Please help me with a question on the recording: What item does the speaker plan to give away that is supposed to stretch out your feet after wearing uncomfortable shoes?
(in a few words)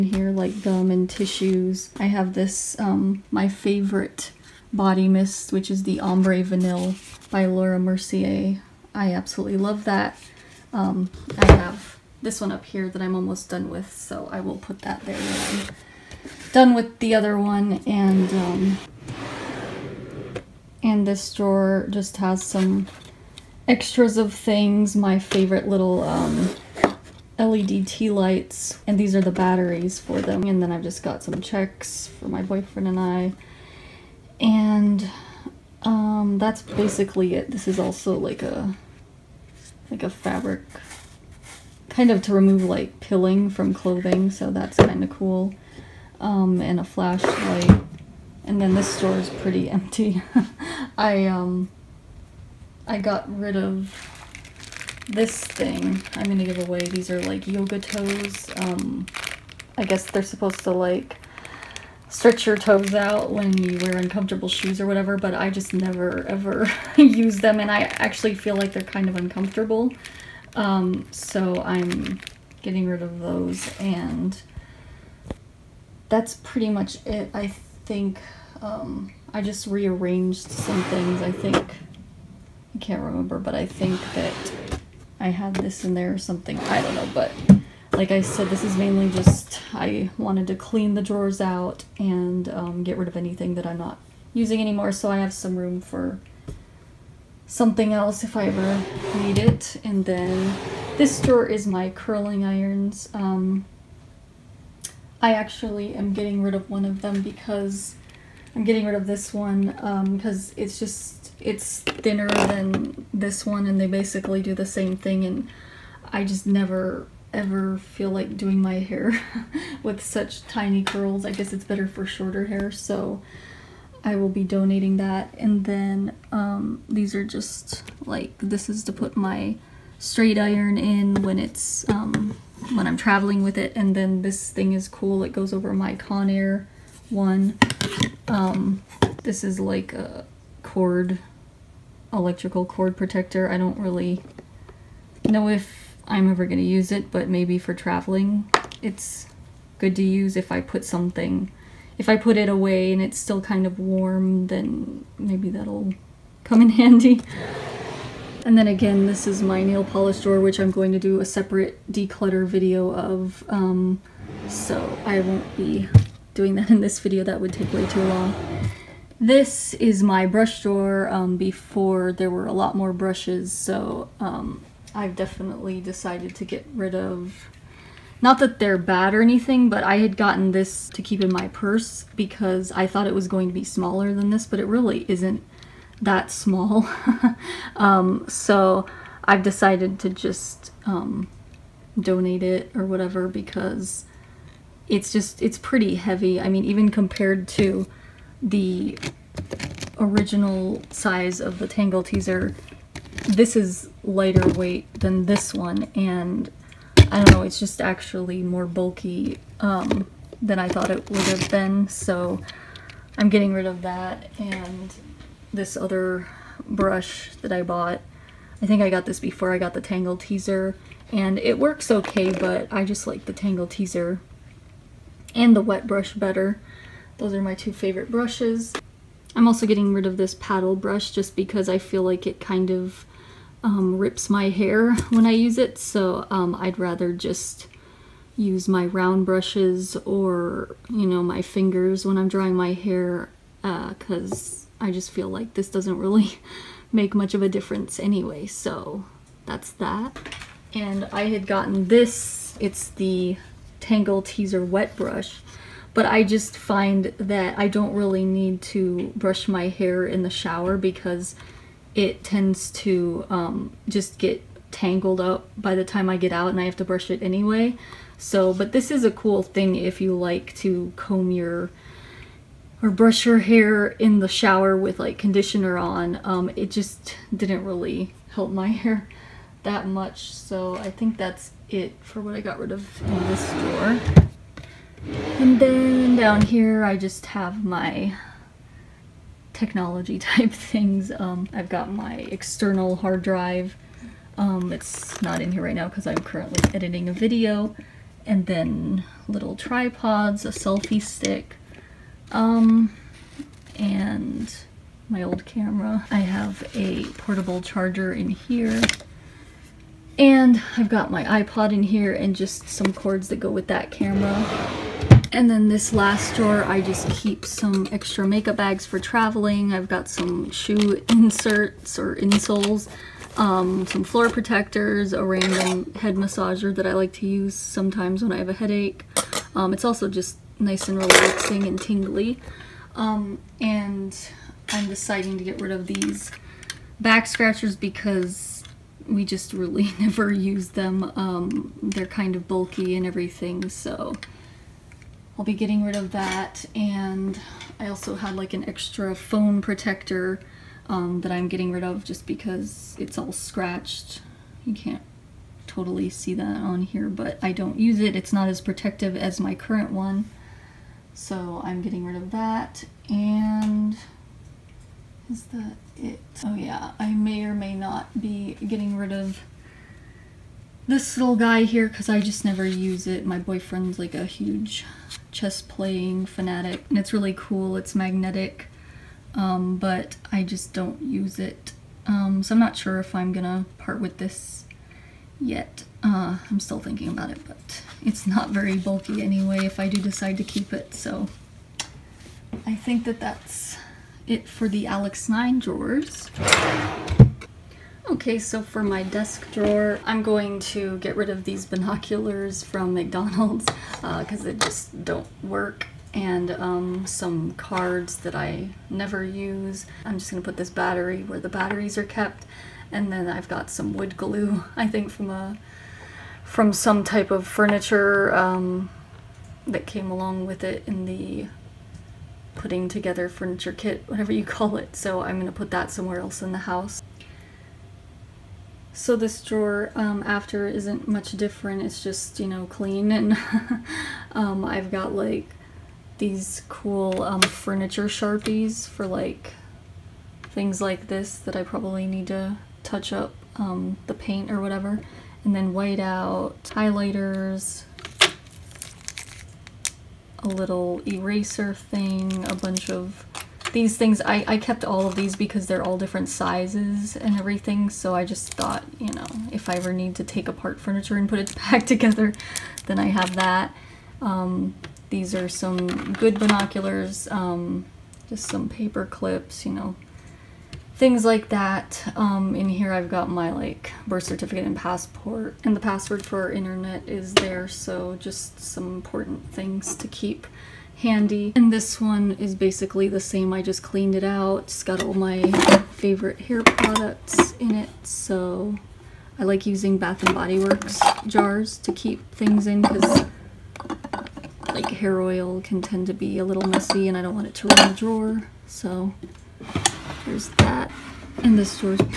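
Yoga toes.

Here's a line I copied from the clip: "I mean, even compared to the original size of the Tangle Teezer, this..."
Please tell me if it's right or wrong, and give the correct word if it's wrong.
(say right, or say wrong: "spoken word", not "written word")
right.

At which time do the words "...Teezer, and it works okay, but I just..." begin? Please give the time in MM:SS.
03:40.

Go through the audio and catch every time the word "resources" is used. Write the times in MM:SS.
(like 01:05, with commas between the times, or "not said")
not said.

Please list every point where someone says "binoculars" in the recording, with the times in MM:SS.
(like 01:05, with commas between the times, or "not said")
06:41, 07:46.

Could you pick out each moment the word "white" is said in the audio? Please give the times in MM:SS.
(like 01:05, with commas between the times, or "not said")
07:25.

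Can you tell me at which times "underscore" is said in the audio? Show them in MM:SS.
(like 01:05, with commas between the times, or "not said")
not said.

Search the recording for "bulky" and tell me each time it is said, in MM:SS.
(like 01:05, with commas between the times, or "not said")
03:28, 05:42, 06:28.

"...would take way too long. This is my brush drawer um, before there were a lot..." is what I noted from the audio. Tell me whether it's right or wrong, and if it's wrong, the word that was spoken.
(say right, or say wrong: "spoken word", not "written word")
right.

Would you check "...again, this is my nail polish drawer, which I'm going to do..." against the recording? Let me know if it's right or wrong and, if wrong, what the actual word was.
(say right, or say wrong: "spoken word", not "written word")
right.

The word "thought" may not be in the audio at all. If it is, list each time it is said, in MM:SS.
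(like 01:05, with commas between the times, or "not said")
03:02, 03:30, 07:38.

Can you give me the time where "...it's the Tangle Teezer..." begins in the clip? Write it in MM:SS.
04:12.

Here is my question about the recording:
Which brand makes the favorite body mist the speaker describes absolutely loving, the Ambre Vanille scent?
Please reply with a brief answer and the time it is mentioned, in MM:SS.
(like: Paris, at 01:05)
Laura Mercier, at 00:07.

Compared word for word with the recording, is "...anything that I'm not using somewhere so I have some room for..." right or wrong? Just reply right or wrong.
wrong.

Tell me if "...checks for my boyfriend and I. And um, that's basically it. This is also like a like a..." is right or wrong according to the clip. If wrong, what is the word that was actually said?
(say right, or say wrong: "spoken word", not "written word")
right.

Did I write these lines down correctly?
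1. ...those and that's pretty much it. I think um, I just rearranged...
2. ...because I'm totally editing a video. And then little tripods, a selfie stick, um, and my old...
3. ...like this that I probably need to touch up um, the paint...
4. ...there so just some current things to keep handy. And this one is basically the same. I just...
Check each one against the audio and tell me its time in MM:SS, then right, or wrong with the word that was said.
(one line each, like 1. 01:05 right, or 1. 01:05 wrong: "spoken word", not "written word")
1. 01:13 right
2. 04:55 wrong: "currently", not "totally"
3. 07:20 right
4. 07:57 wrong: "important", not "current".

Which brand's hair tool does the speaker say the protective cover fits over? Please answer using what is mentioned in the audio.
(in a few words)
Conair.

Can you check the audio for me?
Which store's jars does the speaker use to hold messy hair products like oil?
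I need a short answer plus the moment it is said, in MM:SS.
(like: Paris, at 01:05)
Bath and Body Works, at 08:09.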